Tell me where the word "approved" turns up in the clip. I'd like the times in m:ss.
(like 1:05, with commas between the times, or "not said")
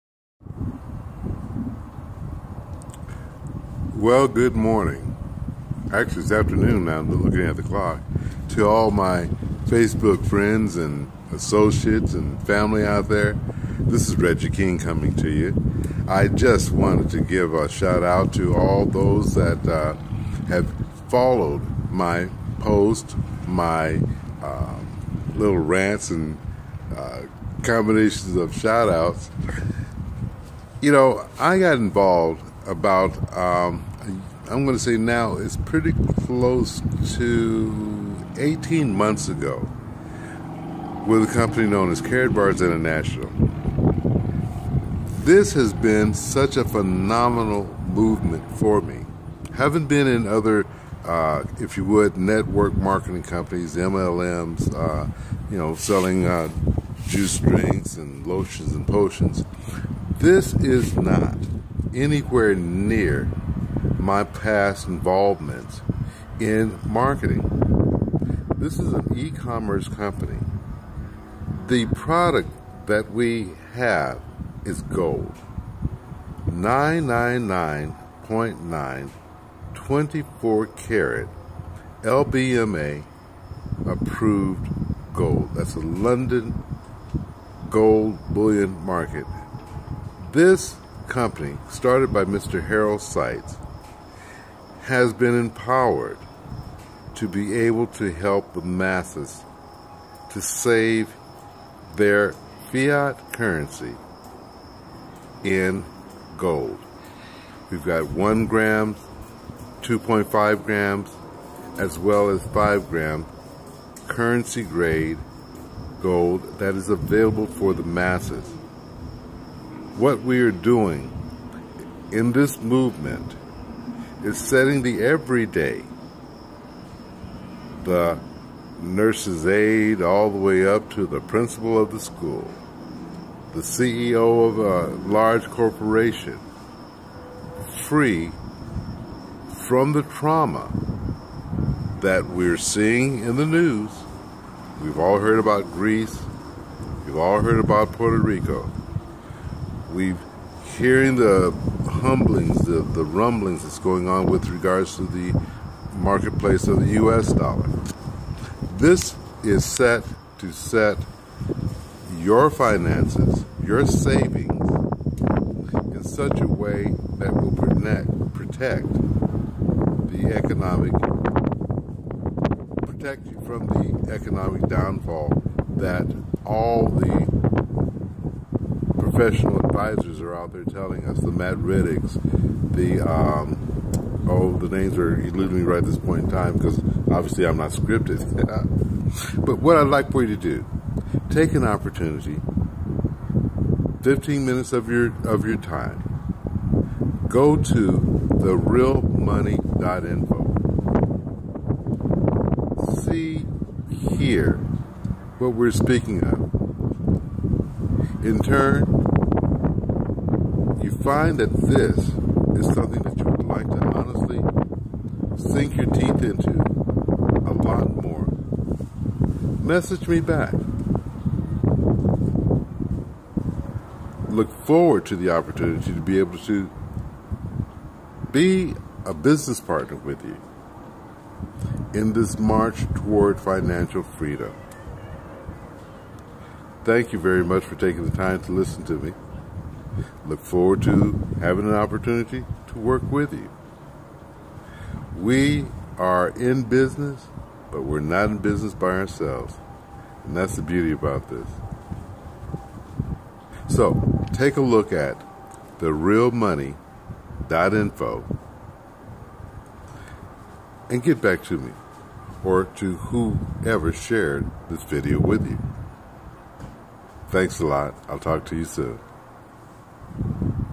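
1:23.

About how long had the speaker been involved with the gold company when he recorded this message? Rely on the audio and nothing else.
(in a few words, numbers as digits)
18 months.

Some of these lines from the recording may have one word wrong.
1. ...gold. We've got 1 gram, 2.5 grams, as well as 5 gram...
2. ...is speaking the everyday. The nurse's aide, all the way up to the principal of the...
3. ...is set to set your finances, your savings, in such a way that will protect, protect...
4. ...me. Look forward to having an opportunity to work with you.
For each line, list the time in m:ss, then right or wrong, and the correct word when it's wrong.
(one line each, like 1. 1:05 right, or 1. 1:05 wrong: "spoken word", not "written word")
1. 1:46 right
2. 2:04 wrong: "setting", not "speaking"
3. 2:39 right
4. 3:58 right.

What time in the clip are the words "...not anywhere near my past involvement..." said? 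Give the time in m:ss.
1:00.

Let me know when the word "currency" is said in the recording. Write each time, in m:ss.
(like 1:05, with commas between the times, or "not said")
1:43, 1:54.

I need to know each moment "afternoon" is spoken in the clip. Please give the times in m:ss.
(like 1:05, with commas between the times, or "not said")
0:06.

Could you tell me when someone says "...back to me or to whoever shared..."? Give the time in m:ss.
4:21.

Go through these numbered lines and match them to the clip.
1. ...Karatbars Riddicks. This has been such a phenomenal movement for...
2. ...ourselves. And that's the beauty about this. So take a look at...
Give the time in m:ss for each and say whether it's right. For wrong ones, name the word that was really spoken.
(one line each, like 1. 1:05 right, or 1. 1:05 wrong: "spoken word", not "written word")
1. 0:42 wrong: "International", not "Riddicks"
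2. 4:08 right.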